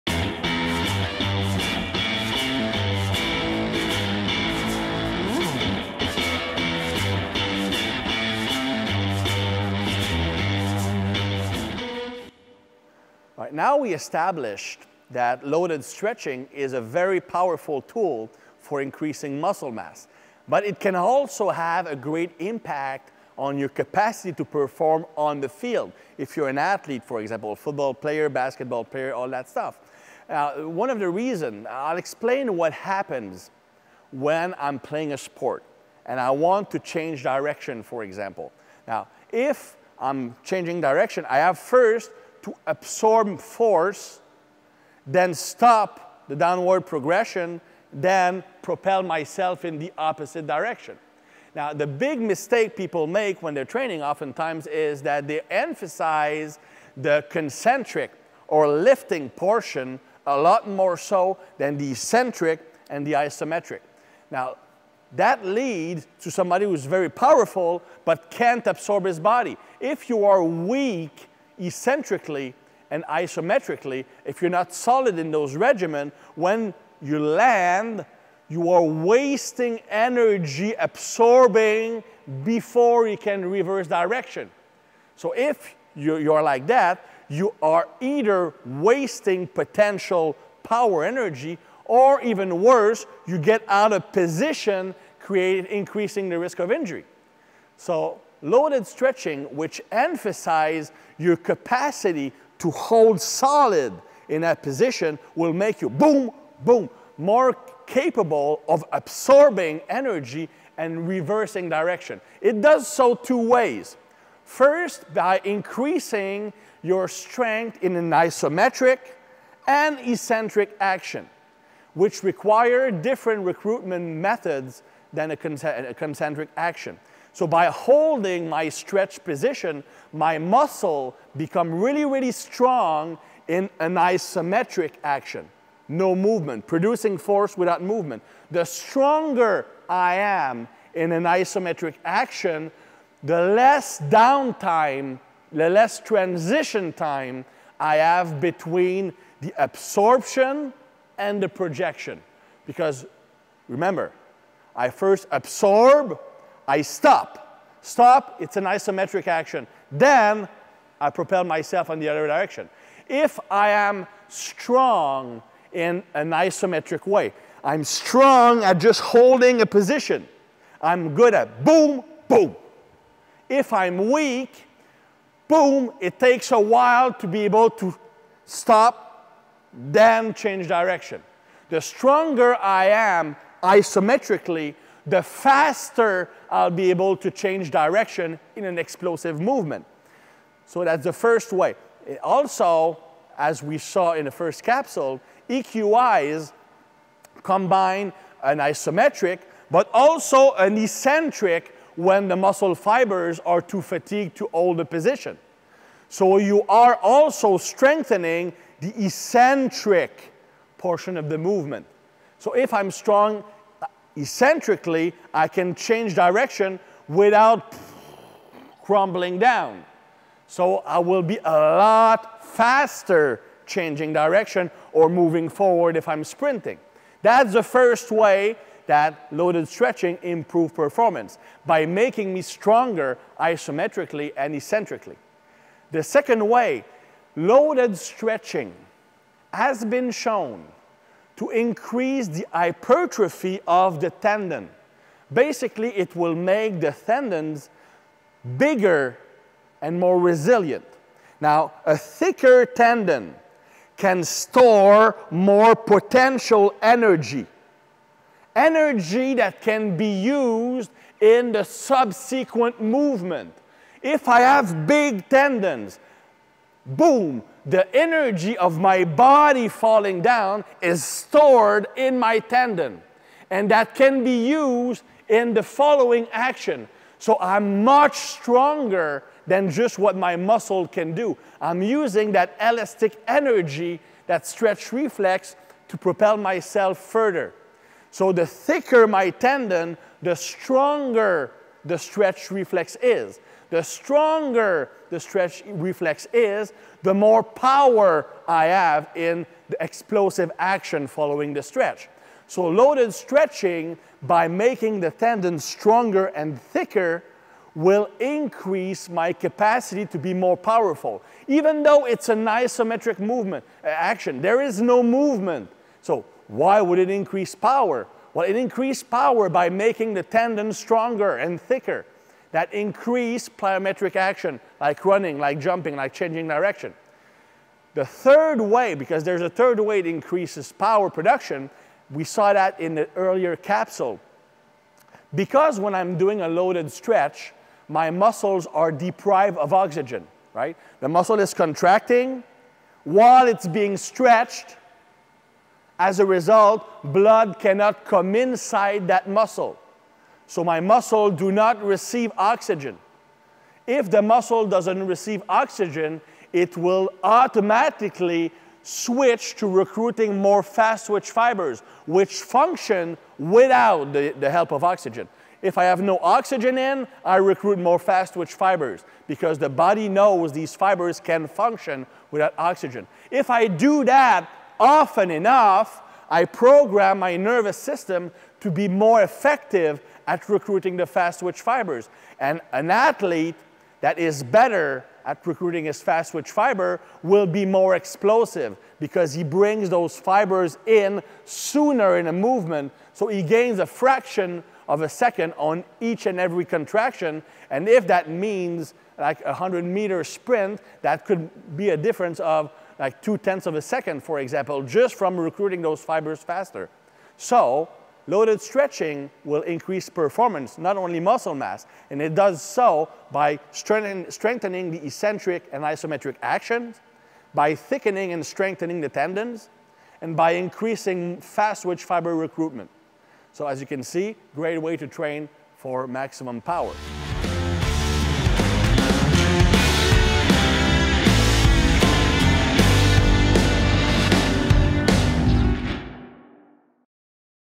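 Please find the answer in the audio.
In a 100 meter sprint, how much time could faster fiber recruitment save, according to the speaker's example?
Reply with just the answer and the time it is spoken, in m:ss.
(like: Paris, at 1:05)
Two tenths of a second, at 6:43.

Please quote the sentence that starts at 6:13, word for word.
If I do that often enough, I program my nervous system to be more effective at recruiting the fast twitch fibers.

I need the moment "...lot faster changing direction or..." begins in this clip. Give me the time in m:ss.
3:41.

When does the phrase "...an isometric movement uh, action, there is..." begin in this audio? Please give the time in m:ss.
5:12.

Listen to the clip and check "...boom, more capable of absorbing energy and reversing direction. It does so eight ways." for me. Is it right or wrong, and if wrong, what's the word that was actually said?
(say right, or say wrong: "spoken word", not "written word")
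wrong: "two", not "eight".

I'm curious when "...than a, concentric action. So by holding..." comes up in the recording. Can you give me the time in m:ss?
2:05.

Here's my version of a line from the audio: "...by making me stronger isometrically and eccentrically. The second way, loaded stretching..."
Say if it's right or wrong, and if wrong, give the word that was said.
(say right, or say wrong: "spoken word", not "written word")
right.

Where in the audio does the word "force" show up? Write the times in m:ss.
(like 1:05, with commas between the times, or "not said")
0:43, 2:17.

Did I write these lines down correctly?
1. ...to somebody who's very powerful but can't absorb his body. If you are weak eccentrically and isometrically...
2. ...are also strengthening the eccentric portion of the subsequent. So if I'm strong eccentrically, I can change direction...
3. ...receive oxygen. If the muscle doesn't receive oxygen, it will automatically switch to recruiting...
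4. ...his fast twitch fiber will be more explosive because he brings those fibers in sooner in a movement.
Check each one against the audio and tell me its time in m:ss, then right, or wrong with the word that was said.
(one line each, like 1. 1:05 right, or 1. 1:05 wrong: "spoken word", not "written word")
1. 1:06 right
2. 3:26 wrong: "movement", not "subsequent"
3. 5:51 right
4. 6:25 right.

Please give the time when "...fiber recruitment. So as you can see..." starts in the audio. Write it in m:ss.
7:02.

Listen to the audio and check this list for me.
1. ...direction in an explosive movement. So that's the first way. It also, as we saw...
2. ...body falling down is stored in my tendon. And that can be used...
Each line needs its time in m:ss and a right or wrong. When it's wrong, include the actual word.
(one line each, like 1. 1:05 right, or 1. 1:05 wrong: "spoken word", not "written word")
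1. 3:07 right
2. 4:29 right.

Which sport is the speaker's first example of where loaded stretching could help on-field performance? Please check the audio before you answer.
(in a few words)
Football.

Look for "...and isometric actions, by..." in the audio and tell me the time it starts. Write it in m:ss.
6:55.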